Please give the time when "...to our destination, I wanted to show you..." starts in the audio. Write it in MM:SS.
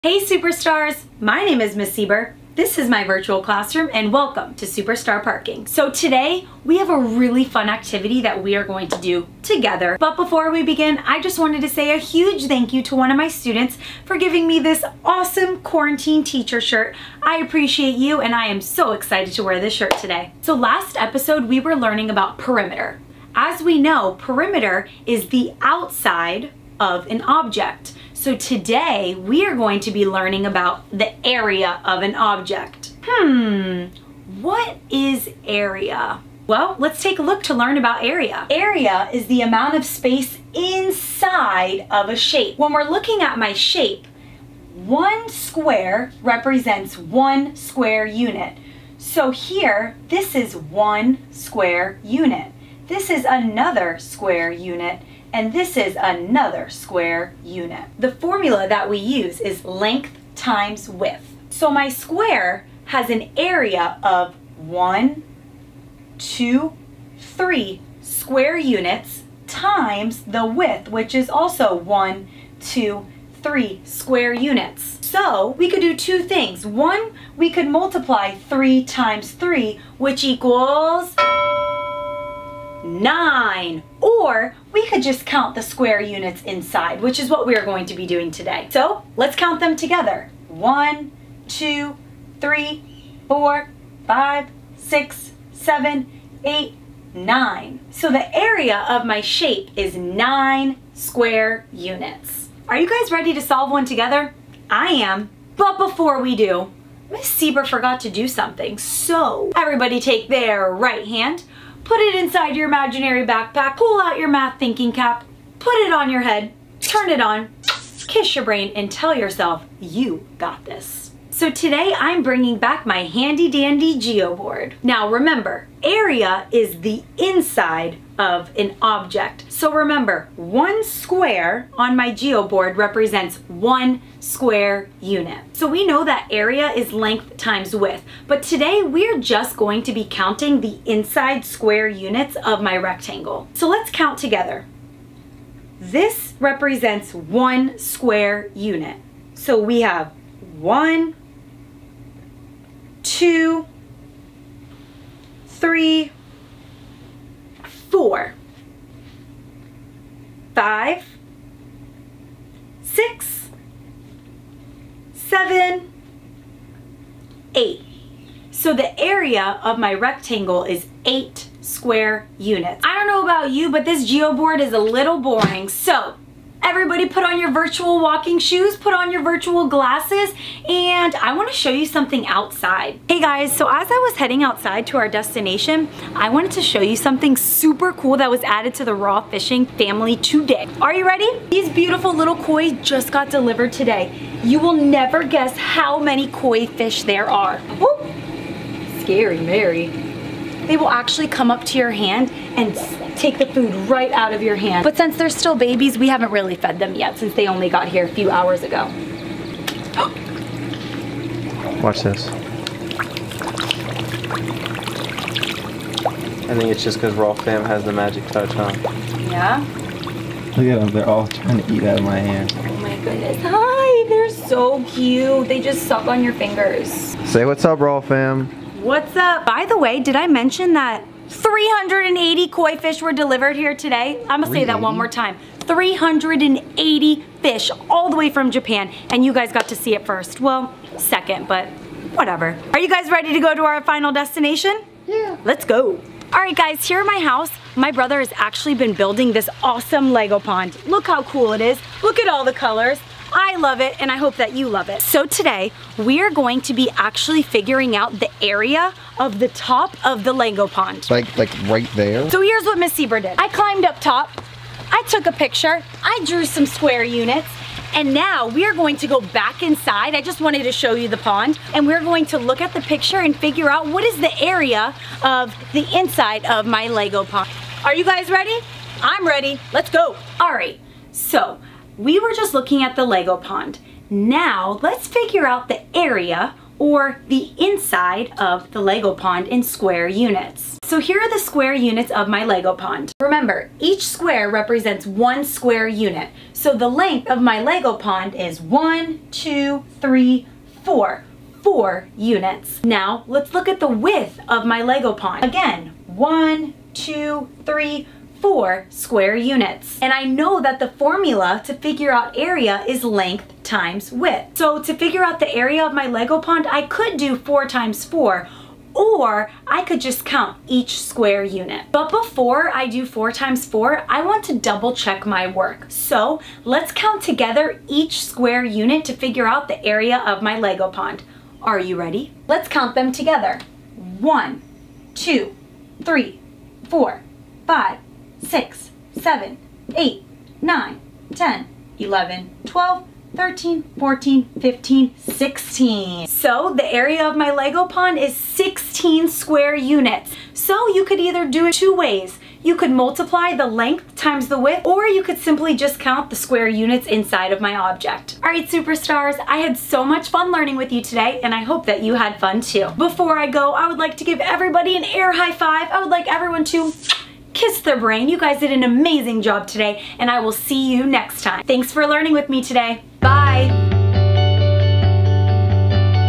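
03:04.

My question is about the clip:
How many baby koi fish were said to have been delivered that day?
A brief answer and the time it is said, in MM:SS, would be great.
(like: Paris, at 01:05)
380, at 03:51.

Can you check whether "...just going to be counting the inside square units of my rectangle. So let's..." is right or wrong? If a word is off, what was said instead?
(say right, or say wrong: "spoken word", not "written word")
right.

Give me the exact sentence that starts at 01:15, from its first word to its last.
So we could do two things.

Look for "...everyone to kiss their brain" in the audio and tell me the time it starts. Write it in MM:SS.
06:06.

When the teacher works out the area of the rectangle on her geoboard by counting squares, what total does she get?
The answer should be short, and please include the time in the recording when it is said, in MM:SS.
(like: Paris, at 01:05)
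8 square units, at 02:51.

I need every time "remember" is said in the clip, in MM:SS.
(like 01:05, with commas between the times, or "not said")
02:05, 02:09, 04:53.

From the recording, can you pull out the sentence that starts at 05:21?
But before I do four times four, I want to double check my work.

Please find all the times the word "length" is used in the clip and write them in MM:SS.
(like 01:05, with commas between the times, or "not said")
00:59, 02:16, 04:56, 05:13, 05:53.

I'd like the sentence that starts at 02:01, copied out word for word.
So today I'm bringing back my handy dandy geoboard.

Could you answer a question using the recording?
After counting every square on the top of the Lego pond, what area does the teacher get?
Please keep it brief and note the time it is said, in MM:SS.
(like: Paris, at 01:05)
16 square units, at 05:48.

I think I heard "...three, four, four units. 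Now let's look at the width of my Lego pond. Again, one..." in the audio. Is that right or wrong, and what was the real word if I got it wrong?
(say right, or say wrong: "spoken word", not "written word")
right.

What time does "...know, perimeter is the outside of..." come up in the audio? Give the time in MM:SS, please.
00:23.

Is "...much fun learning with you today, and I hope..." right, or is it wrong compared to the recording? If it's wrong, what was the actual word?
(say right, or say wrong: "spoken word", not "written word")
right.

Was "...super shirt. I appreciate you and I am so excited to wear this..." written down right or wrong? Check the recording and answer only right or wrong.
wrong.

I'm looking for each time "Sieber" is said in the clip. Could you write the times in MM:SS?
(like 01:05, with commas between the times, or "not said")
00:01, 01:47, 04:22.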